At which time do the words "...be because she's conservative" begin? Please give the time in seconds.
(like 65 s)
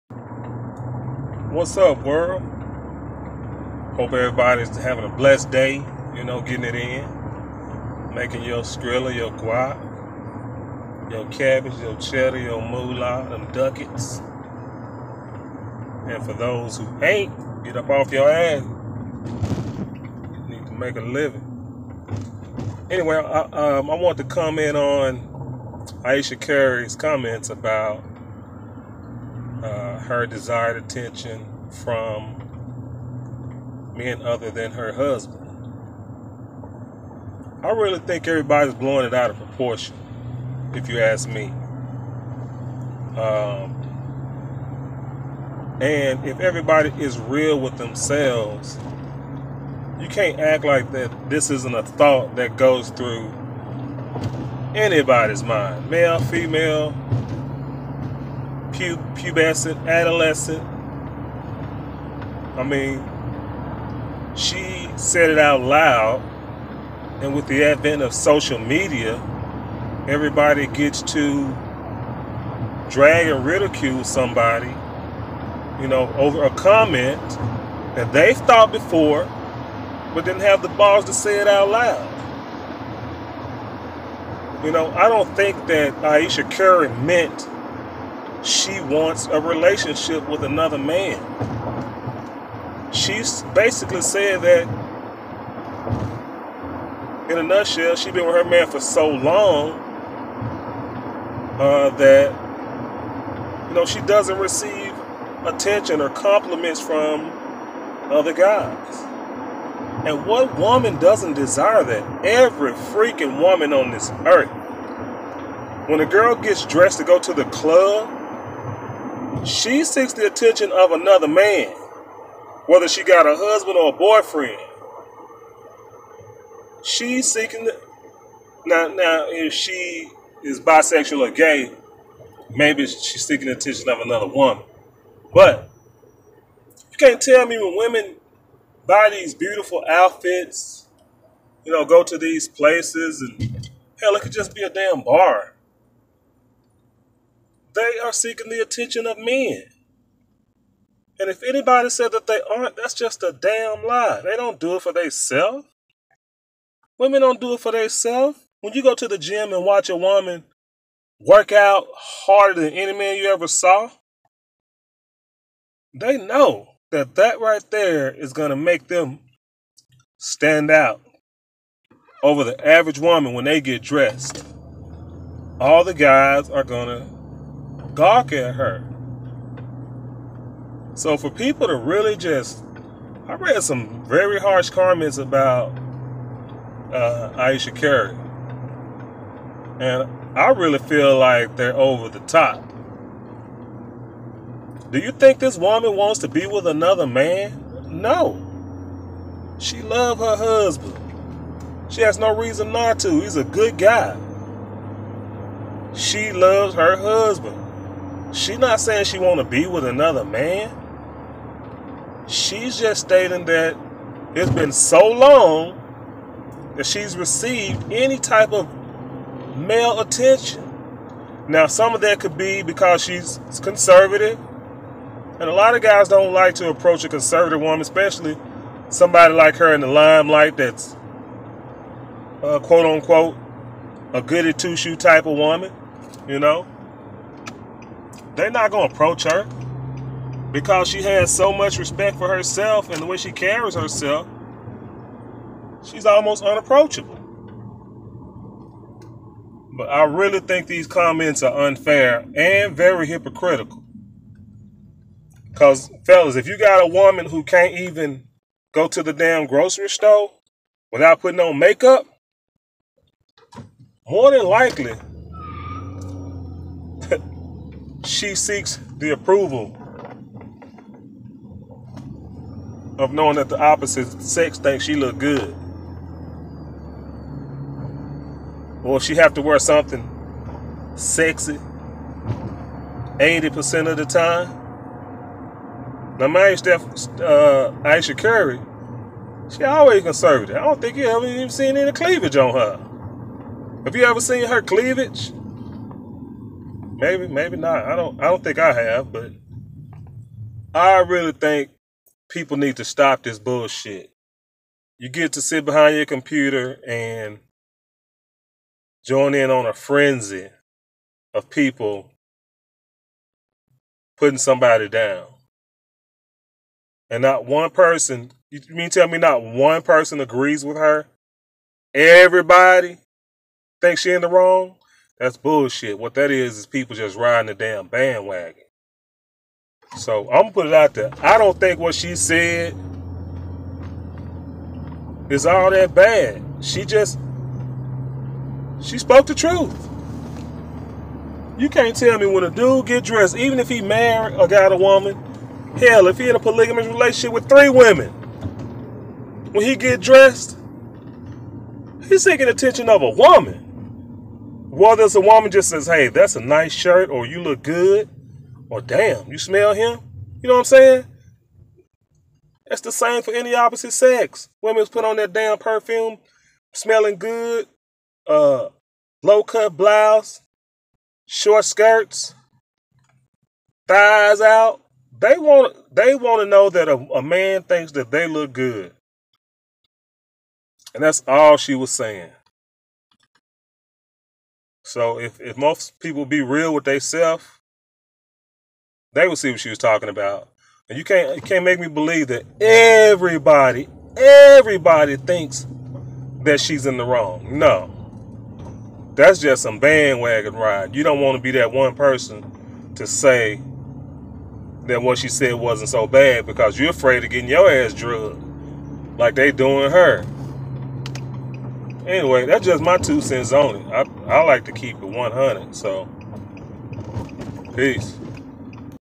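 222 s.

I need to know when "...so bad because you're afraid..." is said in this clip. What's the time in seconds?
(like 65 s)
405 s.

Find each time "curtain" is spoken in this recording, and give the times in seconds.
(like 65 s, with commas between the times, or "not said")
not said.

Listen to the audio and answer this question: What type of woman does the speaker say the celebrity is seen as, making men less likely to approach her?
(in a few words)
goody two shoe.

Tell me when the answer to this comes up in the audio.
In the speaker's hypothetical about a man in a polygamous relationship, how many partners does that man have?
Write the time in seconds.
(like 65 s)
347 s.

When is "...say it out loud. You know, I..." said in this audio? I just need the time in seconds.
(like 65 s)
81 s.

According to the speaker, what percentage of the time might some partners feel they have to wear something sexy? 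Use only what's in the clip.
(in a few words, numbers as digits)
80%.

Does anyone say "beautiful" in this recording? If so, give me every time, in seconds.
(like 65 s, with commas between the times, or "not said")
139 s.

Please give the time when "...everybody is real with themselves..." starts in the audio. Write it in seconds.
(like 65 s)
46 s.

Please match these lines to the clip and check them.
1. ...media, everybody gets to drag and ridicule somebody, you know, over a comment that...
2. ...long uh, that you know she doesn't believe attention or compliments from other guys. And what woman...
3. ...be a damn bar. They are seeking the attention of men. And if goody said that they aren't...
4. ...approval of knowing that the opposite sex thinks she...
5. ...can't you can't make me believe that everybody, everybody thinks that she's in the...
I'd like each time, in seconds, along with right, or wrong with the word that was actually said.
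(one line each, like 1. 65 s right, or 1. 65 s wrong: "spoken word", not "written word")
1. 68 s right
2. 99 s wrong: "receive", not "believe"
3. 144 s wrong: "anybody", not "goody"
4. 269 s right
5. 391 s right.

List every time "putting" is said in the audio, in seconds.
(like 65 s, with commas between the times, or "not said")
261 s, 314 s.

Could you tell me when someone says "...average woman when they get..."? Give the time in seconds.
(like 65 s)
172 s.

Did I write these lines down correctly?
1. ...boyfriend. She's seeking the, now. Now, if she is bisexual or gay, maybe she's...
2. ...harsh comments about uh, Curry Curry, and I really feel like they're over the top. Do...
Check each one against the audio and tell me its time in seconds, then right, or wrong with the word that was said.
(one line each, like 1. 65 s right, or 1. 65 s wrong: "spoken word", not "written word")
1. 123 s right
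2. 184 s wrong: "Ayesha", not "Curry".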